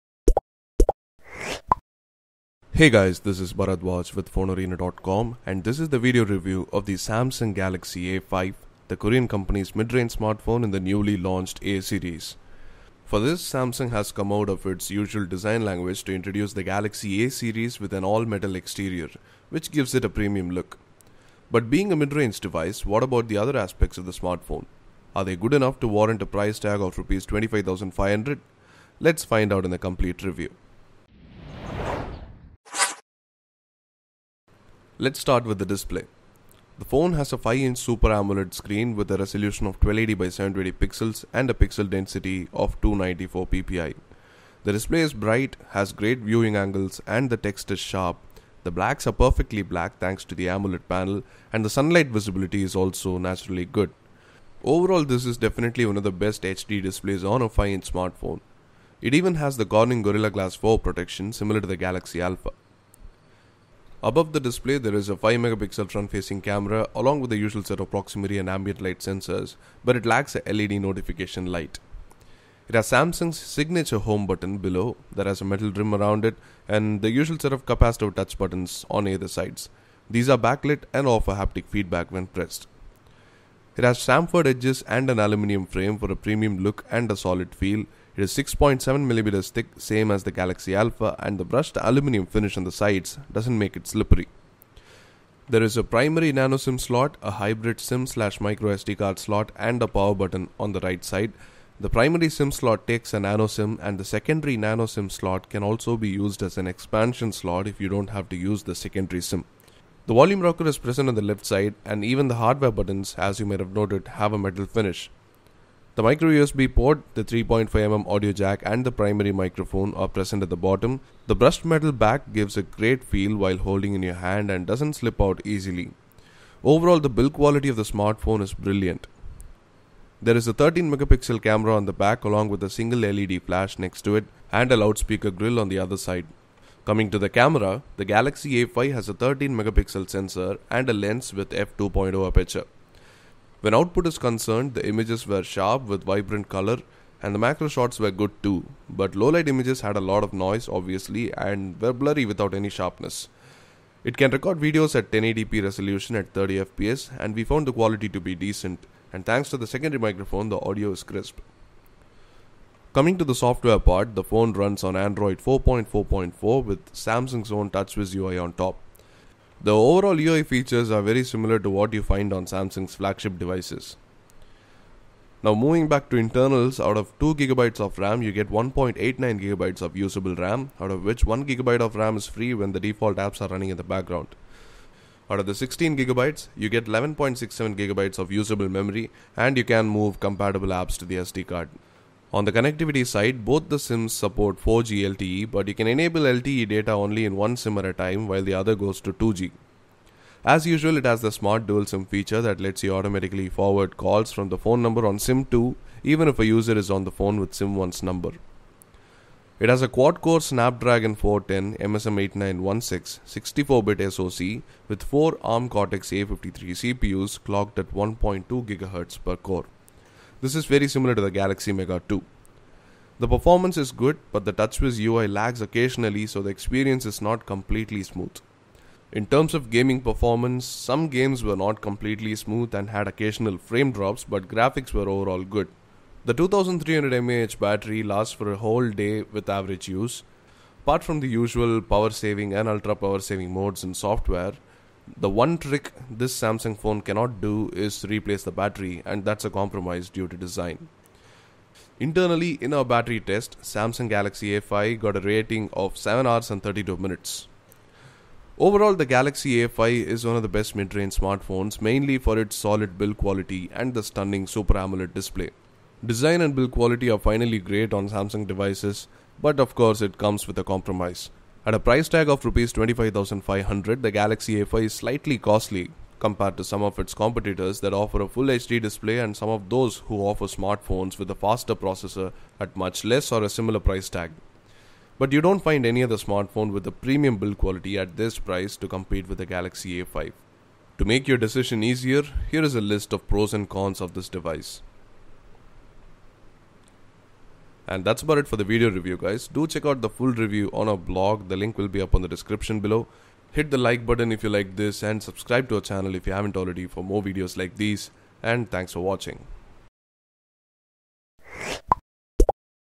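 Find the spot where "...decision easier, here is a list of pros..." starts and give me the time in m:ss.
4:51.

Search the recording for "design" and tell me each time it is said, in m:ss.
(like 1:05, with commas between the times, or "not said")
0:15, 4:10, 4:26.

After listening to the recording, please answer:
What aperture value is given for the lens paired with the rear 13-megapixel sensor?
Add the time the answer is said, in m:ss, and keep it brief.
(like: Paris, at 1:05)
f2.0, at 2:21.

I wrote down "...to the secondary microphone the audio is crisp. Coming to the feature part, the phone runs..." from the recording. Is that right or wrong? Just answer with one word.
wrong.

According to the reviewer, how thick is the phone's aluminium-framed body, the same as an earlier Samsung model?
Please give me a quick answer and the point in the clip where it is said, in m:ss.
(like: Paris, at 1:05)
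6.7 millimeters, at 1:28.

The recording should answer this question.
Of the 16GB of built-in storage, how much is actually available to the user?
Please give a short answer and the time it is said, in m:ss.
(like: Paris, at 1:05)
11.67GB, at 3:06.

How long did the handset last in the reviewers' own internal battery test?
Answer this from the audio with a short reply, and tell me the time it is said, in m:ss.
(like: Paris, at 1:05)
7 hours 32 minutes, at 4:15.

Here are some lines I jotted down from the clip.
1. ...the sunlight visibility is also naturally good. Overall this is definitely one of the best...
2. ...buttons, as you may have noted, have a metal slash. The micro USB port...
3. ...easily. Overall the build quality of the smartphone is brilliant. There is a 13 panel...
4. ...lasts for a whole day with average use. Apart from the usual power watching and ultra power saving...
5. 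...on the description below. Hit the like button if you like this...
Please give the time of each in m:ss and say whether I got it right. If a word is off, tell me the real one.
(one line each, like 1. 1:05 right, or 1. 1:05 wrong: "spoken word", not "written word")
1. 0:51 right
2. 1:52 wrong: "finish", not "slash"
3. 2:05 wrong: "megapixel", not "panel"
4. 3:58 wrong: "saving", not "watching"
5. 5:02 right.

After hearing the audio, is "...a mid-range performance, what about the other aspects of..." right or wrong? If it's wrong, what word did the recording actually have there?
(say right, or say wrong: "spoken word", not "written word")
wrong: "device", not "performance".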